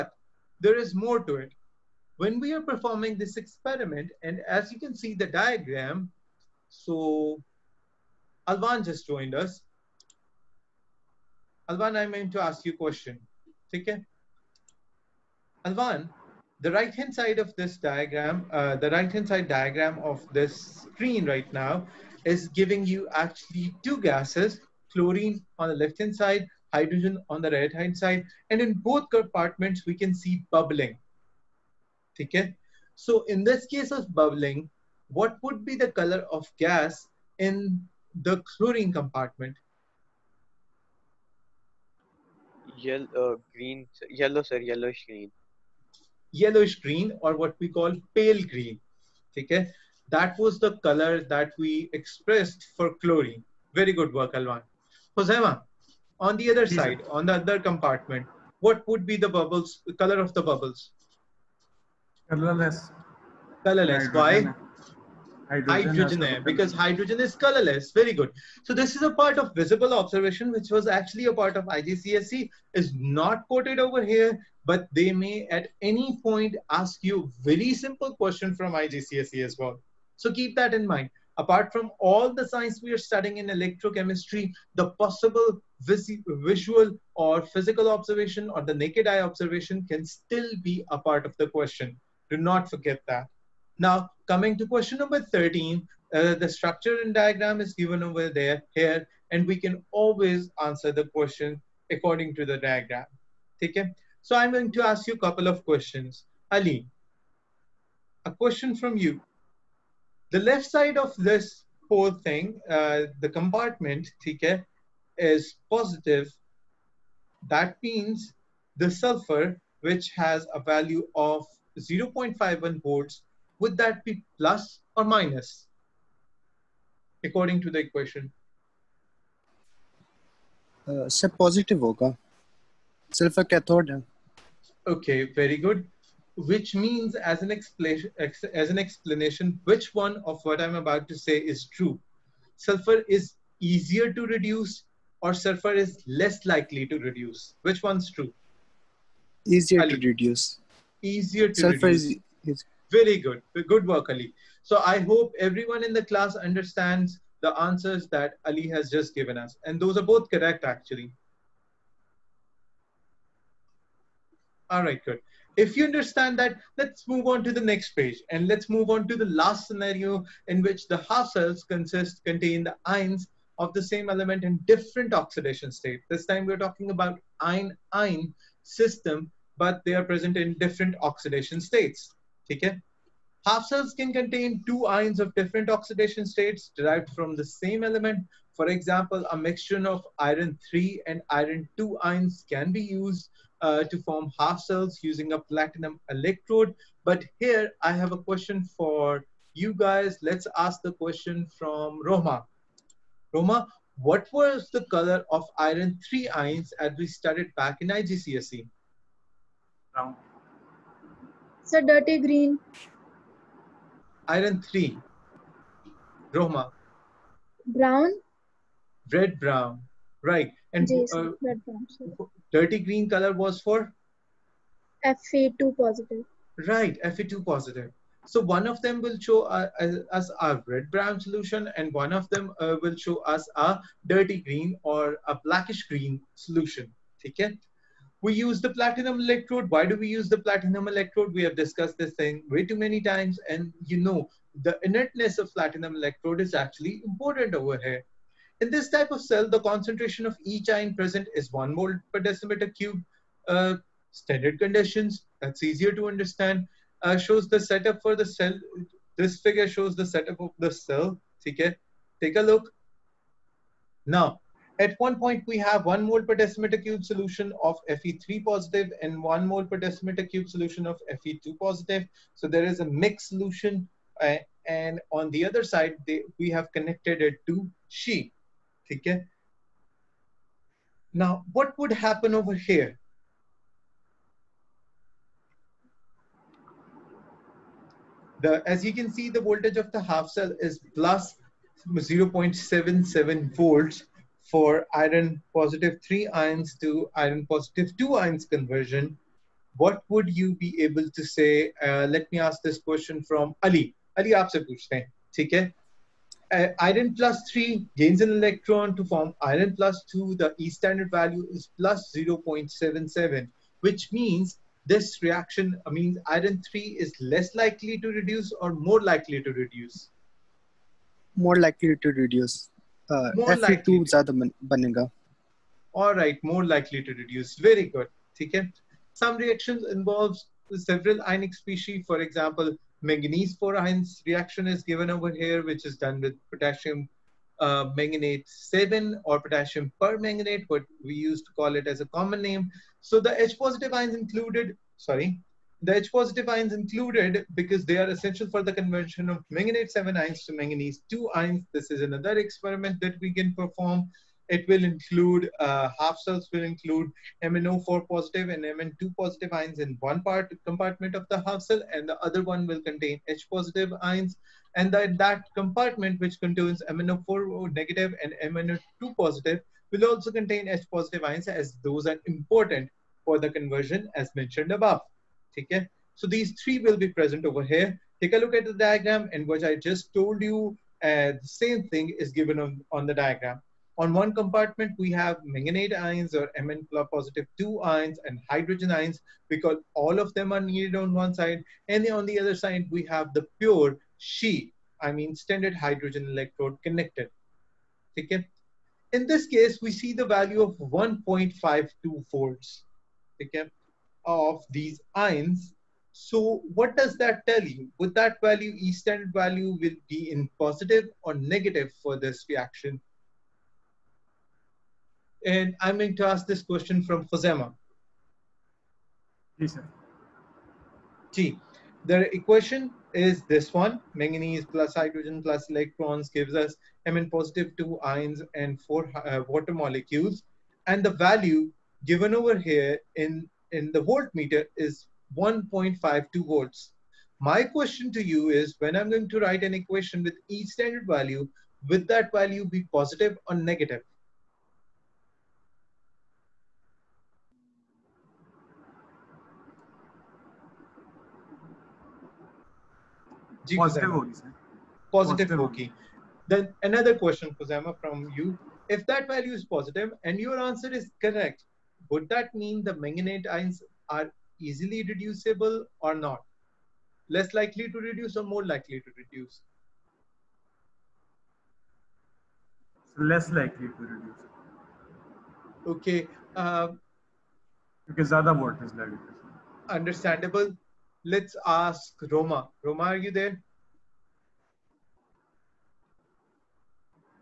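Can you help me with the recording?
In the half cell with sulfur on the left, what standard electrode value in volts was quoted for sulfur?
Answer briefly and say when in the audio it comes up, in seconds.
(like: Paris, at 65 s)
0.51, at 121 s.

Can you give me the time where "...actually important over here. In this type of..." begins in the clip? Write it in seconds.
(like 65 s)
246 s.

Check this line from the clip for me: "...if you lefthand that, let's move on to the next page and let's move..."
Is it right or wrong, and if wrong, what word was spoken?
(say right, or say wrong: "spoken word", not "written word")
wrong: "understand", not "lefthand".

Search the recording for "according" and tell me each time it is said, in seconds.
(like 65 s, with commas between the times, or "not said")
101 s, 127 s.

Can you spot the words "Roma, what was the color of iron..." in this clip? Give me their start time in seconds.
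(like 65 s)
203 s.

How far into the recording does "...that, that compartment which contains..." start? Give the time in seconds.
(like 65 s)
364 s.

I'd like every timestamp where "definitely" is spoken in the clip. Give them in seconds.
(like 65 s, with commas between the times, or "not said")
not said.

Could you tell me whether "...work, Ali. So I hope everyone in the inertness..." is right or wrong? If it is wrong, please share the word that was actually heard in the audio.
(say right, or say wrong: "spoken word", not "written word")
wrong: "class", not "inertness".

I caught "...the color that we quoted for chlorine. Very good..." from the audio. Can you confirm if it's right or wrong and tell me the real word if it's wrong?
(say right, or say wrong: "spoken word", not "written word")
wrong: "expressed", not "quoted".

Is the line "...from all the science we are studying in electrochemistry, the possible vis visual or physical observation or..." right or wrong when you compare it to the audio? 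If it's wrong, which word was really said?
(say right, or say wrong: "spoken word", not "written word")
right.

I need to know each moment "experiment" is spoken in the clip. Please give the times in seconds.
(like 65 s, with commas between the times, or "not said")
3 s, 352 s.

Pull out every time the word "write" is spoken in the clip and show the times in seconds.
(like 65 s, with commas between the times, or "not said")
439 s.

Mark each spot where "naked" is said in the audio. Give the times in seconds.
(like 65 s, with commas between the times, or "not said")
88 s.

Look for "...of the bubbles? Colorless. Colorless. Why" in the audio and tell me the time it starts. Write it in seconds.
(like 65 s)
60 s.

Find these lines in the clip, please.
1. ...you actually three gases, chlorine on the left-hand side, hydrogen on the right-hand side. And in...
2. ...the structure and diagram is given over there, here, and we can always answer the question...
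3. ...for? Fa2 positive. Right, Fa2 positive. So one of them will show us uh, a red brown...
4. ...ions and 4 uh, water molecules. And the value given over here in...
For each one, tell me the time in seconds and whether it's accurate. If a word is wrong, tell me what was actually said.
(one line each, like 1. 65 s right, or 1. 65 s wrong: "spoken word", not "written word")
1. 22 s wrong: "two", not "three"
2. 96 s right
3. 223 s right
4. 427 s right.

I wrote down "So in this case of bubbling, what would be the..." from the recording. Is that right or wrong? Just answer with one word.
right.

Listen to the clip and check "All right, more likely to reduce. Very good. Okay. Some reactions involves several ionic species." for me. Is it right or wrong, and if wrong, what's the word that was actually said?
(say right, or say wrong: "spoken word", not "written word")
right.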